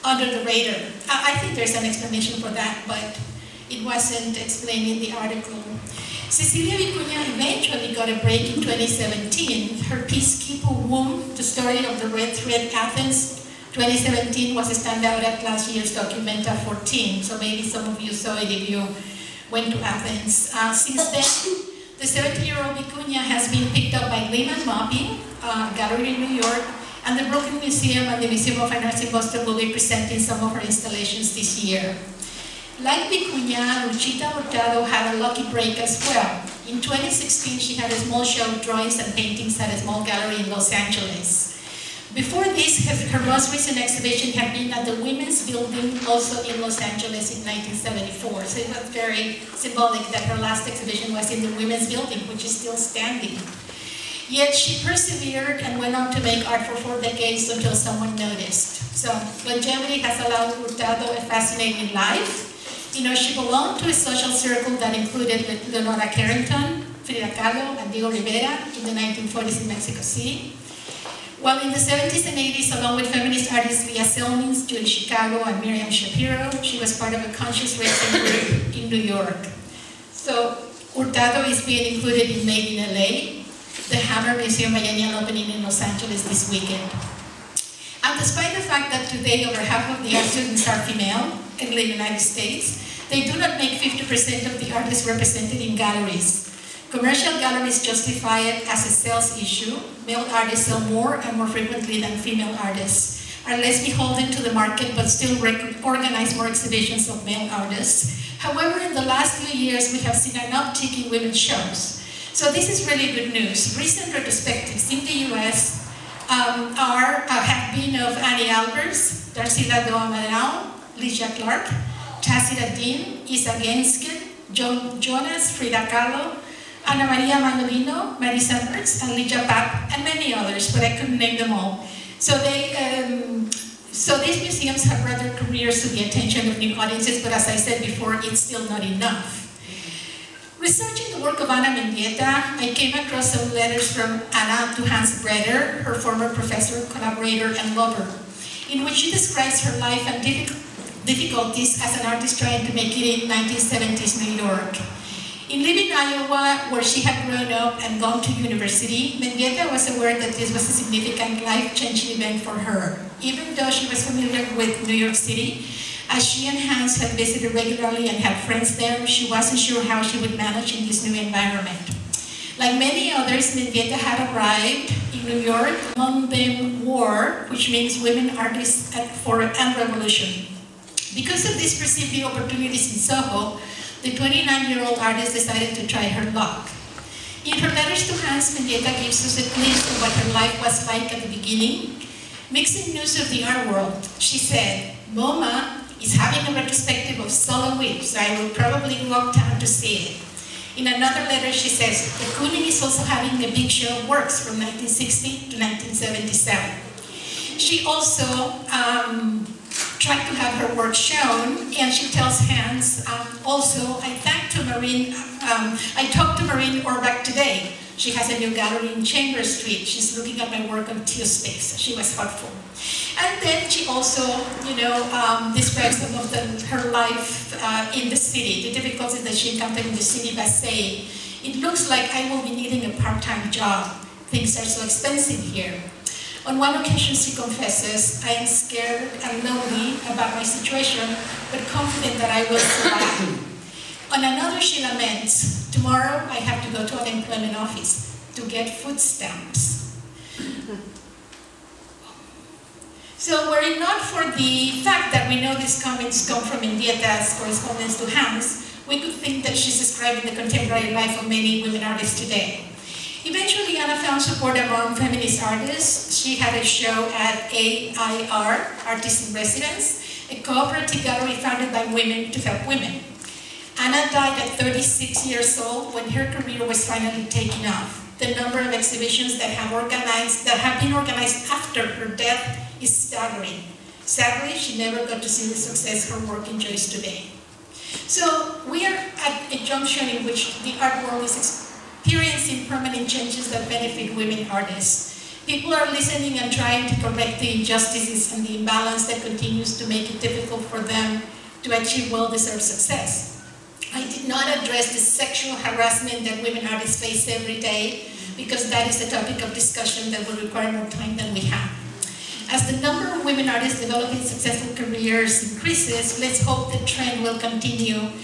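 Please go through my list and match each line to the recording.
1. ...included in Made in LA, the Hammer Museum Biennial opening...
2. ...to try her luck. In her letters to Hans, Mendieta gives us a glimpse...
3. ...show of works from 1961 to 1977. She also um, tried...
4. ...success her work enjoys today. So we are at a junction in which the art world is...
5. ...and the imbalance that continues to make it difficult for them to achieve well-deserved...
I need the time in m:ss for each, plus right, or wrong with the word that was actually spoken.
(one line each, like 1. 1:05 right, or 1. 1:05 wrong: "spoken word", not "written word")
1. 1:21 right
2. 3:05 right
3. 3:23 wrong: "1960", not "1961"
4. 4:45 right
5. 4:58 right.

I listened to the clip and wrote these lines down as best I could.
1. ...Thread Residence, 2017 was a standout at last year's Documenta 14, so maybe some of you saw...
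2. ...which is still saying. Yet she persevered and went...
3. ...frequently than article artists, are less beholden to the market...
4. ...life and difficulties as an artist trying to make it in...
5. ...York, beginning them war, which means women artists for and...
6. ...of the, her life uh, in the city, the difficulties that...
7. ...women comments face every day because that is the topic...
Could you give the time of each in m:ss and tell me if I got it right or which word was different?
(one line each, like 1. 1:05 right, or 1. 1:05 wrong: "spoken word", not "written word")
1. 0:12 wrong: "Athens", not "Residence"
2. 0:52 wrong: "standing", not "saying"
3. 1:41 wrong: "female", not "article"
4. 2:29 right
5. 2:55 wrong: "among", not "beginning"
6. 3:46 right
7. 5:06 wrong: "artists", not "comments".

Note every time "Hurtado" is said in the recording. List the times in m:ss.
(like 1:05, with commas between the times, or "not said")
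0:34, 1:00, 1:20.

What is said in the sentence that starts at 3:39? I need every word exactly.
She's looking at my work on Teospace.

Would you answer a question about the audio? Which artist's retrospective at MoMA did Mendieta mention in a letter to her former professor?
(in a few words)
Sol LeWitt.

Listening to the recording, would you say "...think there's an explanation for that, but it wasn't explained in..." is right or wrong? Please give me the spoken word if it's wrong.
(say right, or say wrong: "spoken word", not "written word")
right.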